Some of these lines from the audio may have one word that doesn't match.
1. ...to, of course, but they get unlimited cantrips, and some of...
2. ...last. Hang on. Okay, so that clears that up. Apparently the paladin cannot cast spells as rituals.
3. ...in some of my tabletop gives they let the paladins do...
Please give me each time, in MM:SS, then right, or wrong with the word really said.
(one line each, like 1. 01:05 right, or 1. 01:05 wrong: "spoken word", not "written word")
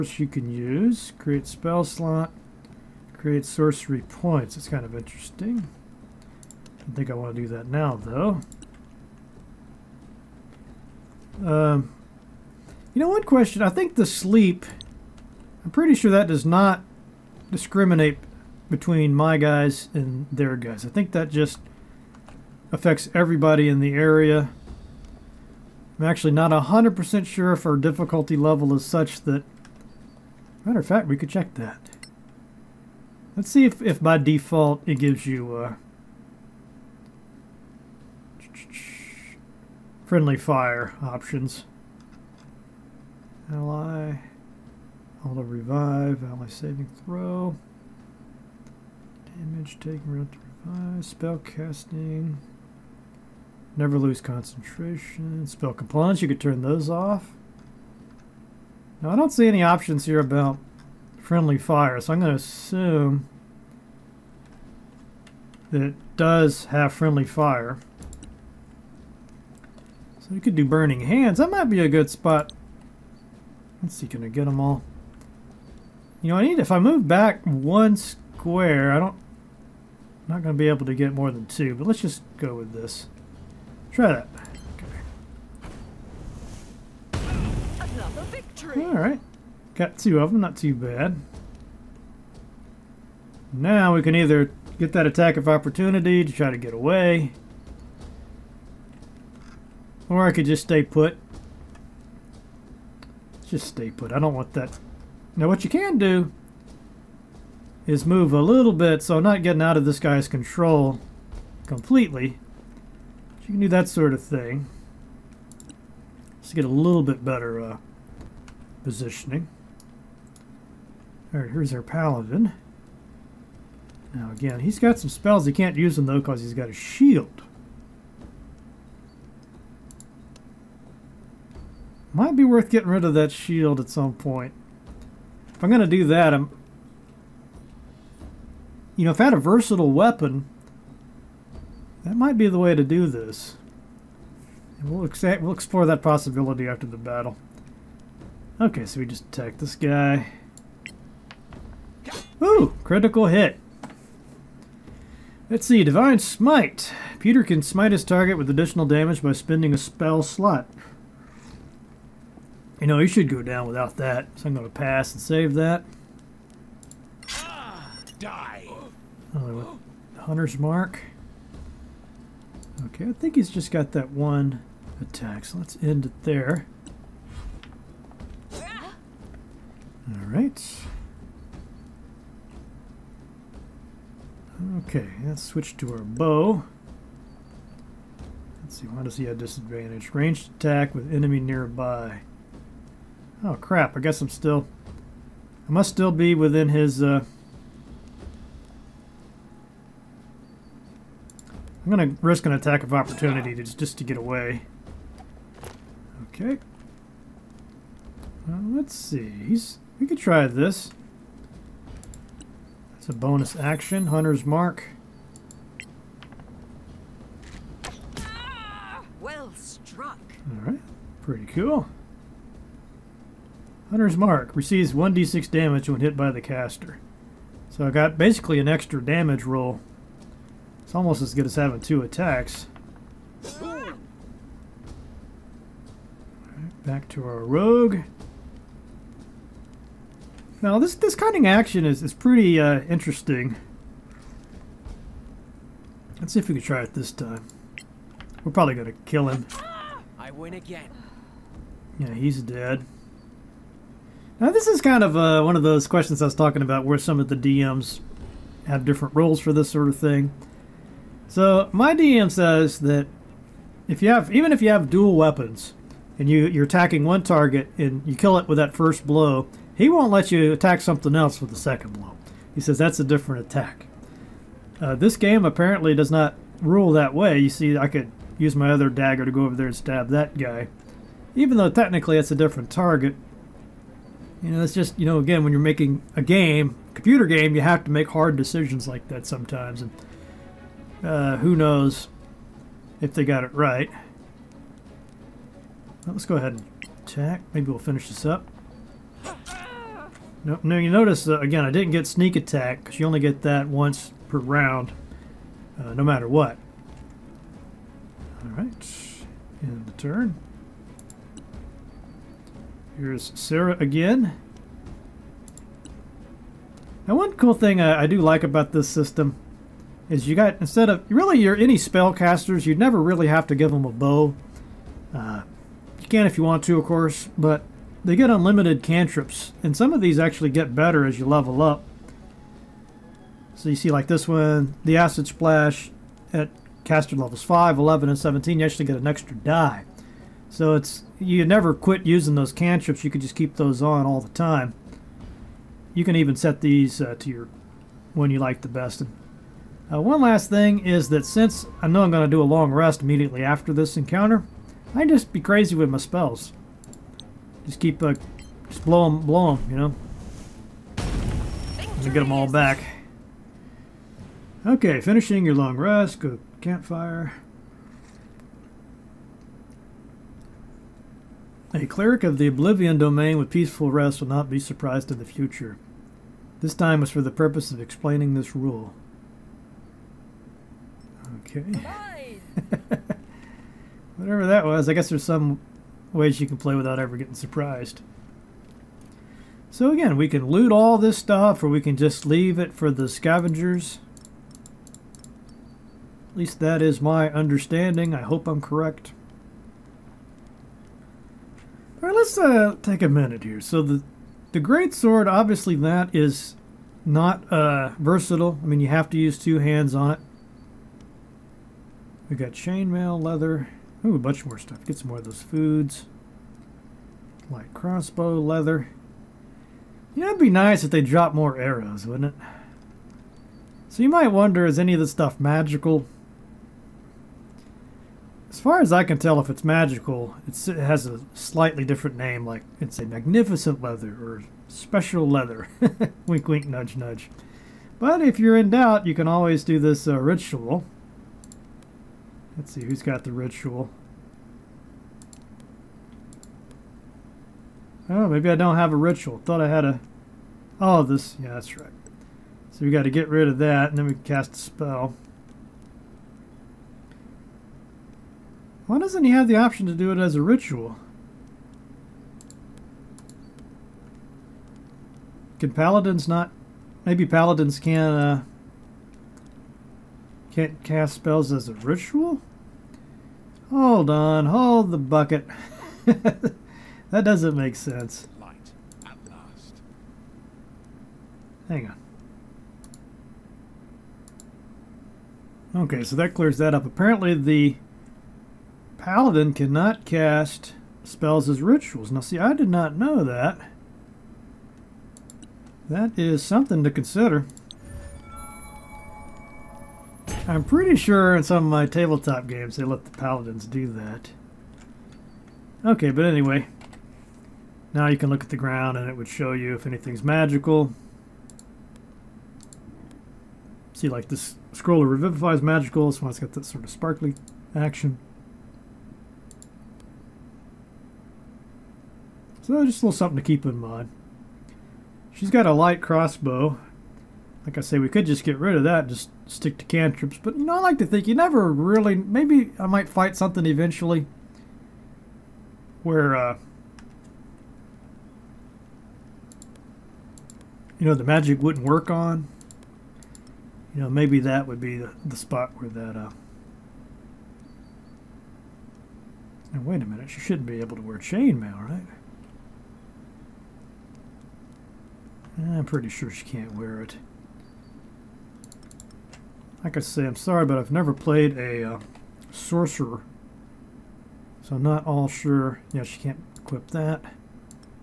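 1. 05:26 right
2. 07:59 right
3. 08:21 wrong: "games", not "gives".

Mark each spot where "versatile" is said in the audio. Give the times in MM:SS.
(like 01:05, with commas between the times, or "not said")
02:19, 06:47.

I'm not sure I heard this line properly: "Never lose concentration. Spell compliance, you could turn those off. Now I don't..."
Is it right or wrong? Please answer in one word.
right.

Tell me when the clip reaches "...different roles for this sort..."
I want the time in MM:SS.
04:18.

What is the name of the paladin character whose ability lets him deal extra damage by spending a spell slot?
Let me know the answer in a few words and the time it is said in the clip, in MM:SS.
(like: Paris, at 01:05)
Peter, at 02:37.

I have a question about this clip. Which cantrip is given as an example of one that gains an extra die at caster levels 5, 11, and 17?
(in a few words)
Acid Splash.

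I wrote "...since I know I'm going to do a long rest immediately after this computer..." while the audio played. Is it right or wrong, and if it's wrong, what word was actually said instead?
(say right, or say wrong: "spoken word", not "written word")
wrong: "encounter", not "computer".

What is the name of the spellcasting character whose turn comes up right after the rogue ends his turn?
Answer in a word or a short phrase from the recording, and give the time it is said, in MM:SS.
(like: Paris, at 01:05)
Sarah, at 05:13.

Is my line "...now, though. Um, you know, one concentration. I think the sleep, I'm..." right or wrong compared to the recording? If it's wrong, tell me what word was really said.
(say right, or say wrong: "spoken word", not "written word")
wrong: "question", not "concentration".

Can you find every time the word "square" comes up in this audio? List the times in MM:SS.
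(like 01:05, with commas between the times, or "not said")
01:17.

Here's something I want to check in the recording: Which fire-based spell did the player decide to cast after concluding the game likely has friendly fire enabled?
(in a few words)
Burning Hands.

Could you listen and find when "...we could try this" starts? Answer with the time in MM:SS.
03:29.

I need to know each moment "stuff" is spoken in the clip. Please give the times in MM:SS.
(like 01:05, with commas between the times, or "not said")
06:31, 06:54, 07:05.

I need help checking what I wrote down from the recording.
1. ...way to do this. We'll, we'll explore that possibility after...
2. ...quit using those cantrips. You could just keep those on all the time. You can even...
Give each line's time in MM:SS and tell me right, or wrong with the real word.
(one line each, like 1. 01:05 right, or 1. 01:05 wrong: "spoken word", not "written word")
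1. 02:22 right
2. 05:41 right.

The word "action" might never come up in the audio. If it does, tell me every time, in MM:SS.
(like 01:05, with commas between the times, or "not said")
03:33, 04:01, 08:37.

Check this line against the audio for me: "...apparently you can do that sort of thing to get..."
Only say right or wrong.
wrong.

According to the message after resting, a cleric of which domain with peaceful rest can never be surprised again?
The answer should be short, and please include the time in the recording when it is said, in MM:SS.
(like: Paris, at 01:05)
Oblivion, at 06:12.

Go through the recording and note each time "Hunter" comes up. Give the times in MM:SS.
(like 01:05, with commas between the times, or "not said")
02:50, 03:34, 03:43.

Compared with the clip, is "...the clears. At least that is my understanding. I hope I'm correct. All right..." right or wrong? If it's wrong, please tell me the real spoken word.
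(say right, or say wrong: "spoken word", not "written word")
wrong: "scavengers", not "clears".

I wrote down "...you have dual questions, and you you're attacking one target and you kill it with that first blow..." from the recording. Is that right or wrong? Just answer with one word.
wrong.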